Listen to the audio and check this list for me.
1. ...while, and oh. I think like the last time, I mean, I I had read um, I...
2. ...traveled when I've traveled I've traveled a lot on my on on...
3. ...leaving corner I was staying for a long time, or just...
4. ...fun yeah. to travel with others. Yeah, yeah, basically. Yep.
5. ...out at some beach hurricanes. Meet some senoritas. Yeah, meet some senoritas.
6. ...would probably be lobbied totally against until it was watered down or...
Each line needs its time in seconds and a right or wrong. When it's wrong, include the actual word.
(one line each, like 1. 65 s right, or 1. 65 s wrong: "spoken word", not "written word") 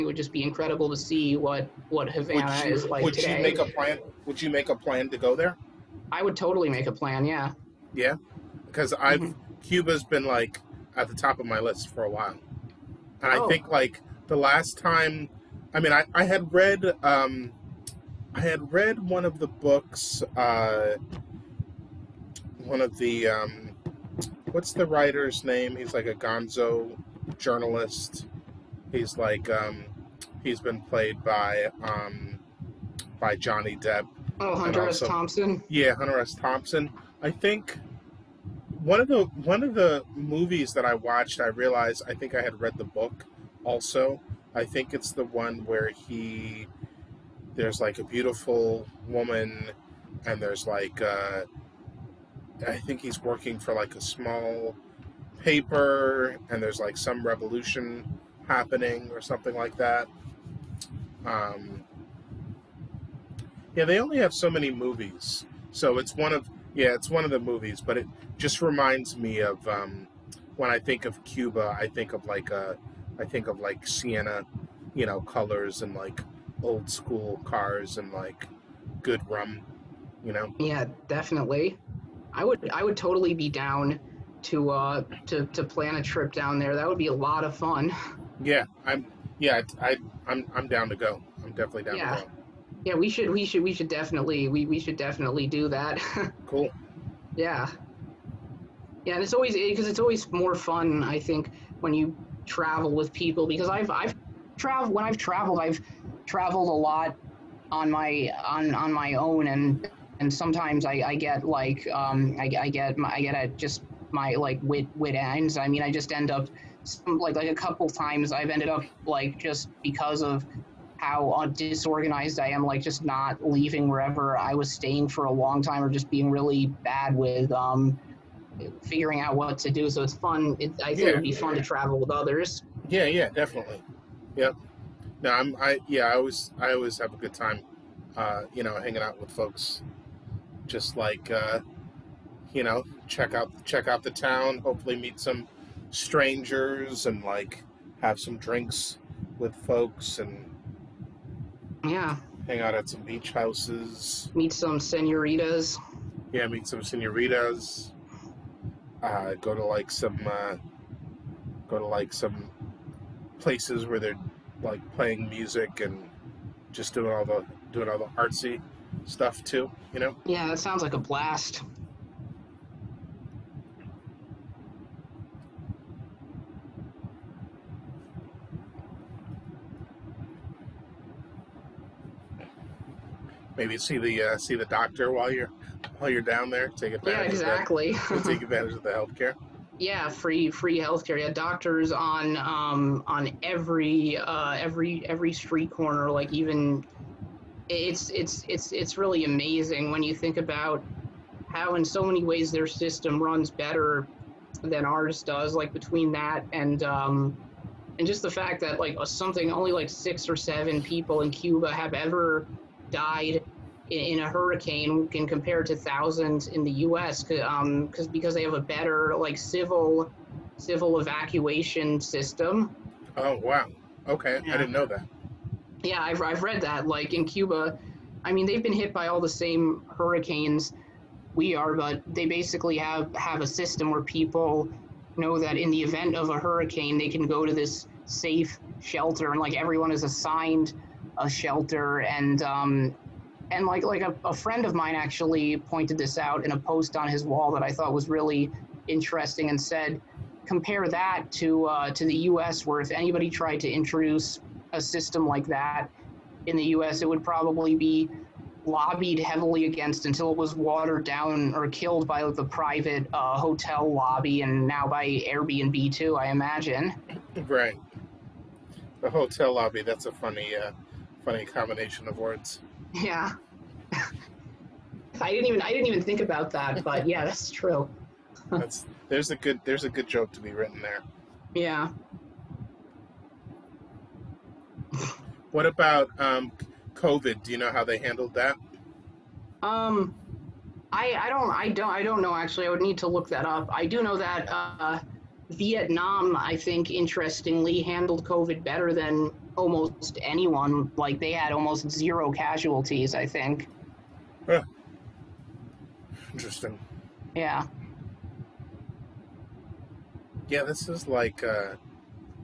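1. 12 s right
2. 104 s right
3. 123 s wrong: "wherever", not "corner"
4. 131 s wrong: "definitely", not "basically"
5. 152 s wrong: "houses", not "hurricanes"
6. 257 s wrong: "heavily", not "totally".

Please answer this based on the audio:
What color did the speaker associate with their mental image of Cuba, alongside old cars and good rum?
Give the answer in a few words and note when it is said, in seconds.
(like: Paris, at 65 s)
Sienna, at 73 s.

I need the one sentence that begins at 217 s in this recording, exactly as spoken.
Um, cause, because they have a better like civil civil evacuation system.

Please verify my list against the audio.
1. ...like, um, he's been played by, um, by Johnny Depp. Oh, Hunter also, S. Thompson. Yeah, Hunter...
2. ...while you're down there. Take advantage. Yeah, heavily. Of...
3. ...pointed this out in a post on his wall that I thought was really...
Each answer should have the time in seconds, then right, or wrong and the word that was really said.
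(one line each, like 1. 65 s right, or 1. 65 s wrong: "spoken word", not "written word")
1. 29 s right
2. 185 s wrong: "exactly", not "heavily"
3. 245 s right.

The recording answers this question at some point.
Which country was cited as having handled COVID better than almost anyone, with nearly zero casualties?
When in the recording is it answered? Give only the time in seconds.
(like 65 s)
295 s.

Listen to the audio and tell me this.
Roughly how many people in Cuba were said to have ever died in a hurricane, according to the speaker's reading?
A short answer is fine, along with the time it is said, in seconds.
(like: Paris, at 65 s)
6 or 7, at 209 s.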